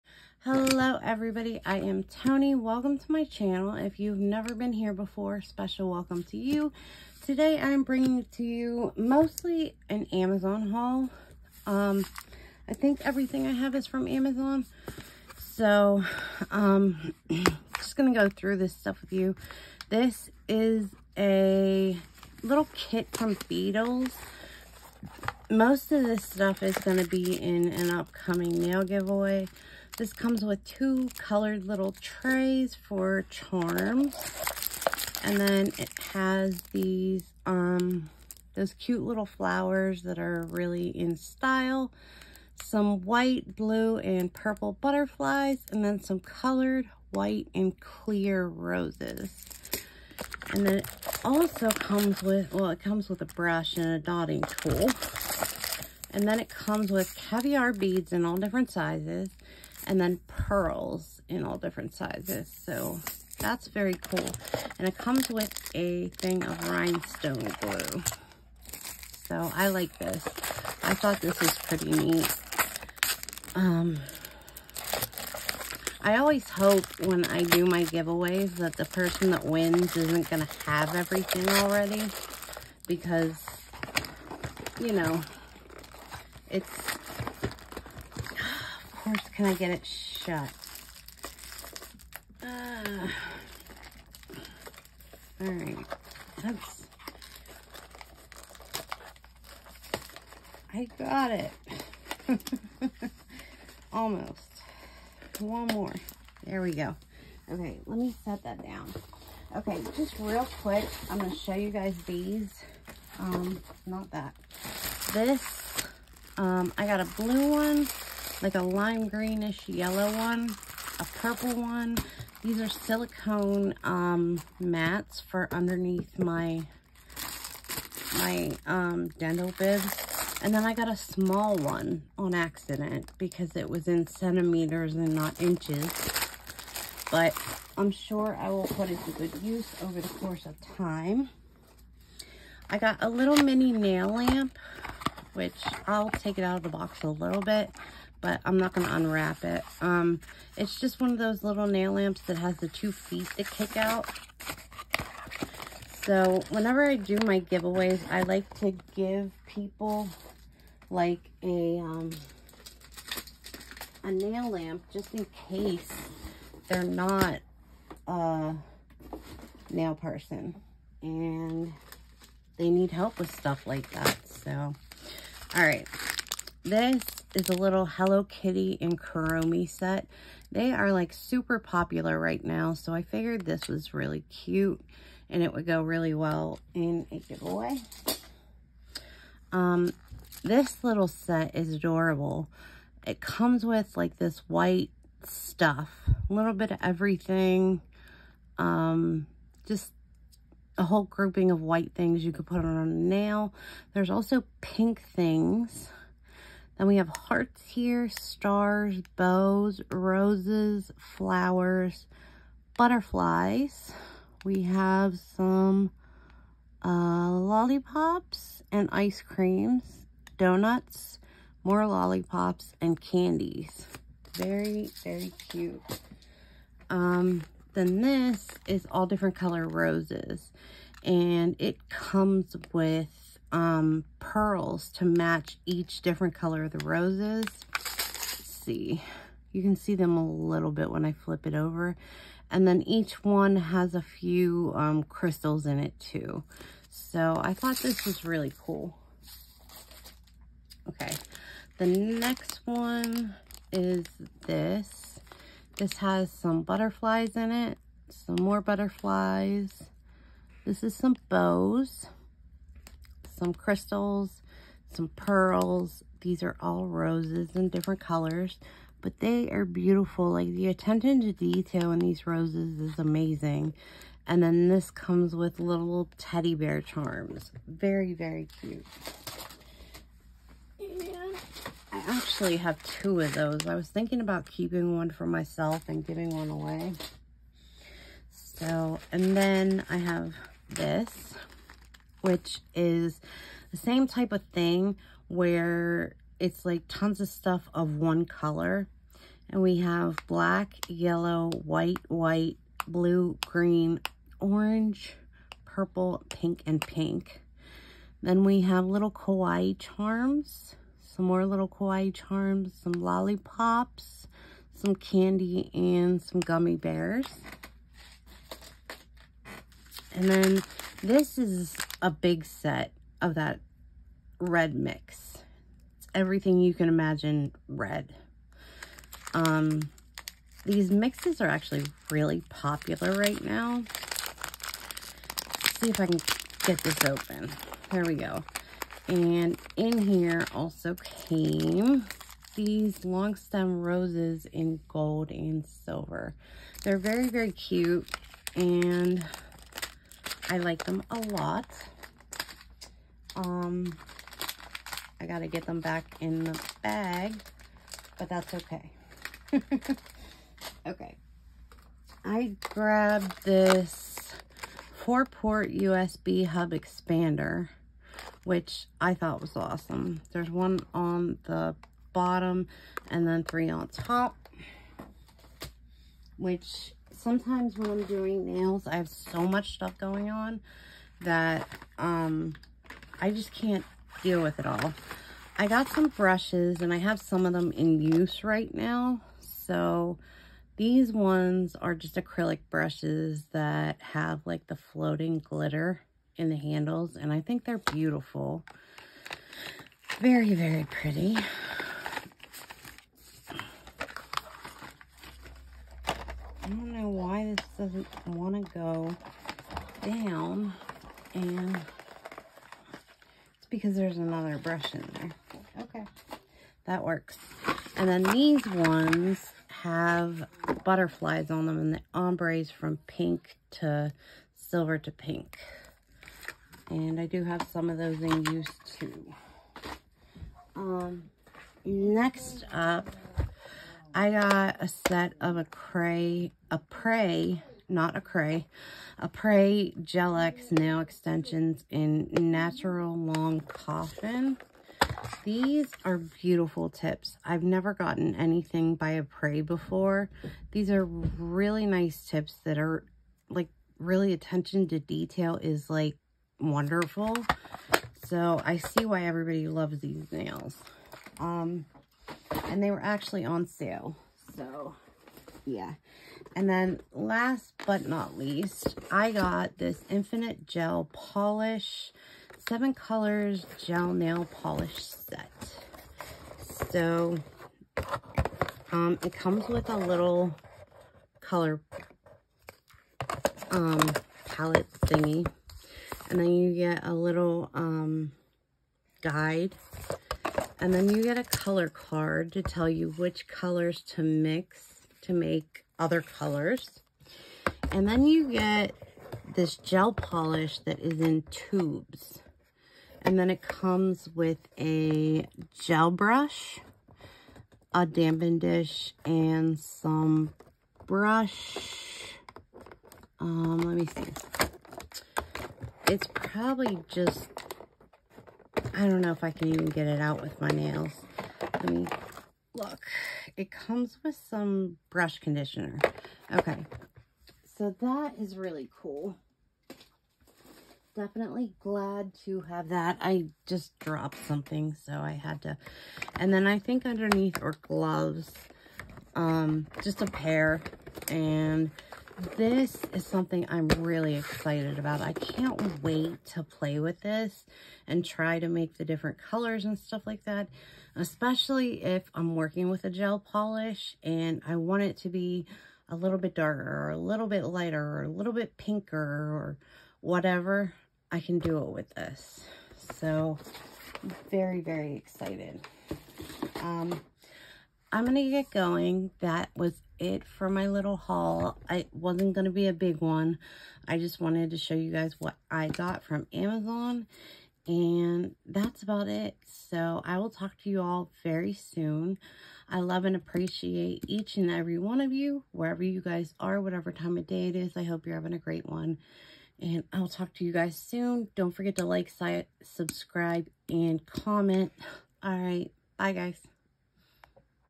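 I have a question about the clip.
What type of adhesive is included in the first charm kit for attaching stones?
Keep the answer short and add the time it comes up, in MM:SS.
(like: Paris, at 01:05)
rhinestone glue, at 01:06.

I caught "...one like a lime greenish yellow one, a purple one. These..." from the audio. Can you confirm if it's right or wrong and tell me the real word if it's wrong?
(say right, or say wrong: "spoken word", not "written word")
right.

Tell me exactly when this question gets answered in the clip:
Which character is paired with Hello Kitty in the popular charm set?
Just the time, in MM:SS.
02:58.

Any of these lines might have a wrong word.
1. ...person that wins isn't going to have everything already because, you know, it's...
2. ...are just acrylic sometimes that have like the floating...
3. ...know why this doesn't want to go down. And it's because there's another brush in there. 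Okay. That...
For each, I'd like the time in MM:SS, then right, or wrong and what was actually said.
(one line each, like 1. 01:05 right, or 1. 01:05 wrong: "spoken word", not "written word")
1. 01:18 right
2. 06:31 wrong: "brushes", not "sometimes"
3. 06:46 right.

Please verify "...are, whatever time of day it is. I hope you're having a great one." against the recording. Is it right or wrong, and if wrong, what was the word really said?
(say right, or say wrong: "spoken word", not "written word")
right.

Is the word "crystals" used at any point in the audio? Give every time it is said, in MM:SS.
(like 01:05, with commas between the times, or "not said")
04:05, 04:23.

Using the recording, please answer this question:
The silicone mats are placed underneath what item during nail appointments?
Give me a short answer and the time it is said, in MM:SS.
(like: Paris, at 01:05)
dental bibs, at 02:09.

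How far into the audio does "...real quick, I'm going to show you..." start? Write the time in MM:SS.
01:50.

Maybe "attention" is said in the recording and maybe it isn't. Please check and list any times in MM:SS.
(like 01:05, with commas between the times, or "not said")
04:30, 07:34.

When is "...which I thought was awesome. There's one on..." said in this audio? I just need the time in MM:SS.
06:08.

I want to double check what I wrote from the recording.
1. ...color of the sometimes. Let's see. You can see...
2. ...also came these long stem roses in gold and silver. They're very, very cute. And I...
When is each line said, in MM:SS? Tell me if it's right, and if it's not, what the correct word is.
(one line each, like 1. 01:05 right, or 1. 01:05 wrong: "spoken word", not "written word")
1. 03:56 wrong: "roses", not "sometimes"
2. 05:40 right.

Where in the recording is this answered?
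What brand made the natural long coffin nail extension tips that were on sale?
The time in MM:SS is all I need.
07:19.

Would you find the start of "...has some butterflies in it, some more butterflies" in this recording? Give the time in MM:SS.
04:15.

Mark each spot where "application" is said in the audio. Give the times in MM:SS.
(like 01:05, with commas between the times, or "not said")
not said.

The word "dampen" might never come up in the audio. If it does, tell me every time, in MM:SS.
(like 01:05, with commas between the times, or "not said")
08:28.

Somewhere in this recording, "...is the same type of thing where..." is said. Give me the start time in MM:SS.
04:52.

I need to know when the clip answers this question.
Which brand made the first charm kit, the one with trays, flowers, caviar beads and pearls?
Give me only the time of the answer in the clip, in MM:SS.
00:23.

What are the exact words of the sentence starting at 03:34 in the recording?
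We have some uh, lollipops and ice creams, donuts, more lollipops, and candies.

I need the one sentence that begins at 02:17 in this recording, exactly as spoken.
But I'm sure I will put it to good use over the course of time.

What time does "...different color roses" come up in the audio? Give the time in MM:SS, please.
03:49.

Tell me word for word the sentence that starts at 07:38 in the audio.
So I see why everybody loves these nails.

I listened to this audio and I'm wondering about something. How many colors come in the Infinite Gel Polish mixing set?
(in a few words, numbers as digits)
7.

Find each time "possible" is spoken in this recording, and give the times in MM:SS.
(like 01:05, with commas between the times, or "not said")
not said.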